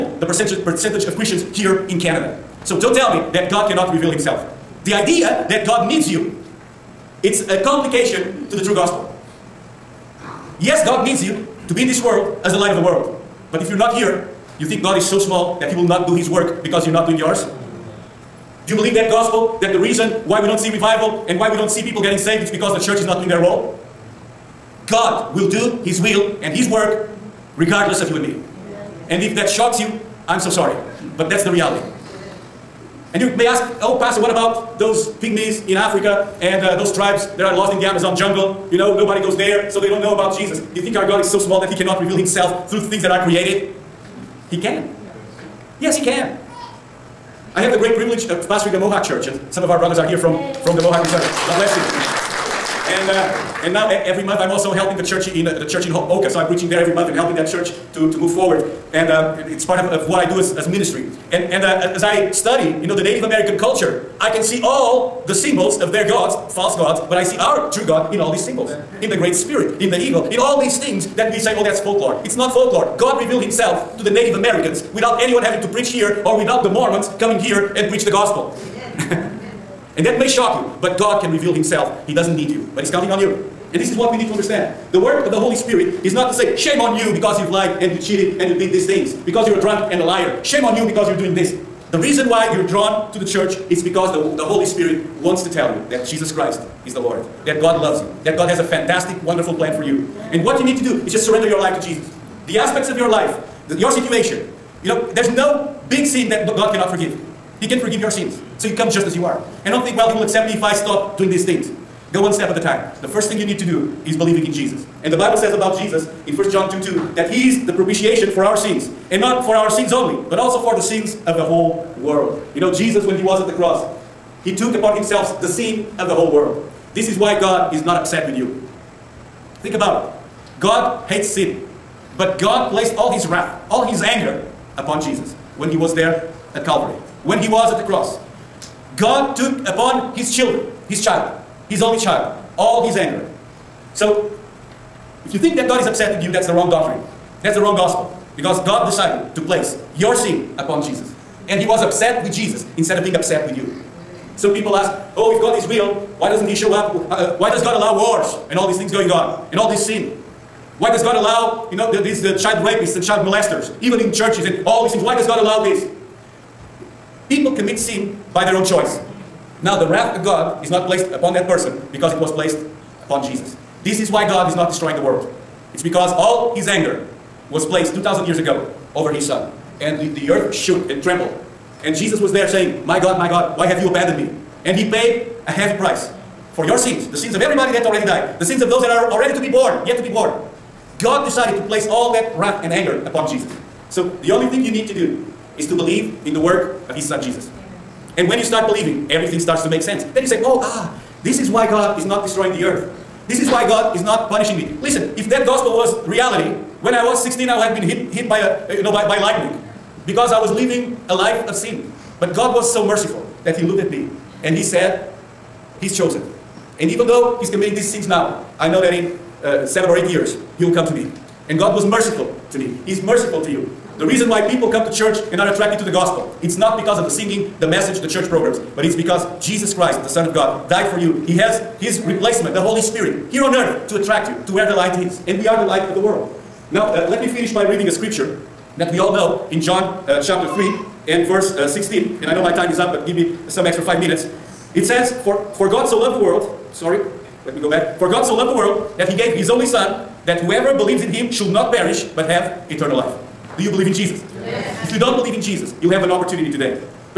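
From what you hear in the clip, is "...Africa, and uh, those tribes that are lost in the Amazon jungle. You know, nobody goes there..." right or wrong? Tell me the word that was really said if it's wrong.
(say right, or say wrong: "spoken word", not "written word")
right.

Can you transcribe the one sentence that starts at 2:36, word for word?
Uh, uh, why does God allow wars and all these things going on and all this sin?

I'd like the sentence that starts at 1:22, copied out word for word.
He doesn't need you, but He's counting on you.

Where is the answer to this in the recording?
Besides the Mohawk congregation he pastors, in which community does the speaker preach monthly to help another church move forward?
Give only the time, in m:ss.
0:55.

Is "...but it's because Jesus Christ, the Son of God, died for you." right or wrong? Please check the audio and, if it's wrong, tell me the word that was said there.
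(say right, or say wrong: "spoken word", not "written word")
right.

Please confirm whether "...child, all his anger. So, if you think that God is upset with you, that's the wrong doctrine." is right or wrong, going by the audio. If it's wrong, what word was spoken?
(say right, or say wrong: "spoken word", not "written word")
right.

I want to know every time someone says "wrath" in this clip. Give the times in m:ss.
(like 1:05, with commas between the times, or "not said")
2:13, 2:49, 3:12.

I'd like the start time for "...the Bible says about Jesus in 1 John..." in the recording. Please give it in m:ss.
1:55.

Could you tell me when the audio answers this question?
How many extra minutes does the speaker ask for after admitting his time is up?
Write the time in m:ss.
4:03.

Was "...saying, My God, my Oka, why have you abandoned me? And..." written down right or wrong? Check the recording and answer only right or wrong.
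wrong.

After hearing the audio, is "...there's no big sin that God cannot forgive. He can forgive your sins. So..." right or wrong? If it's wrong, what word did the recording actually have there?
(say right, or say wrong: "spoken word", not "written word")
right.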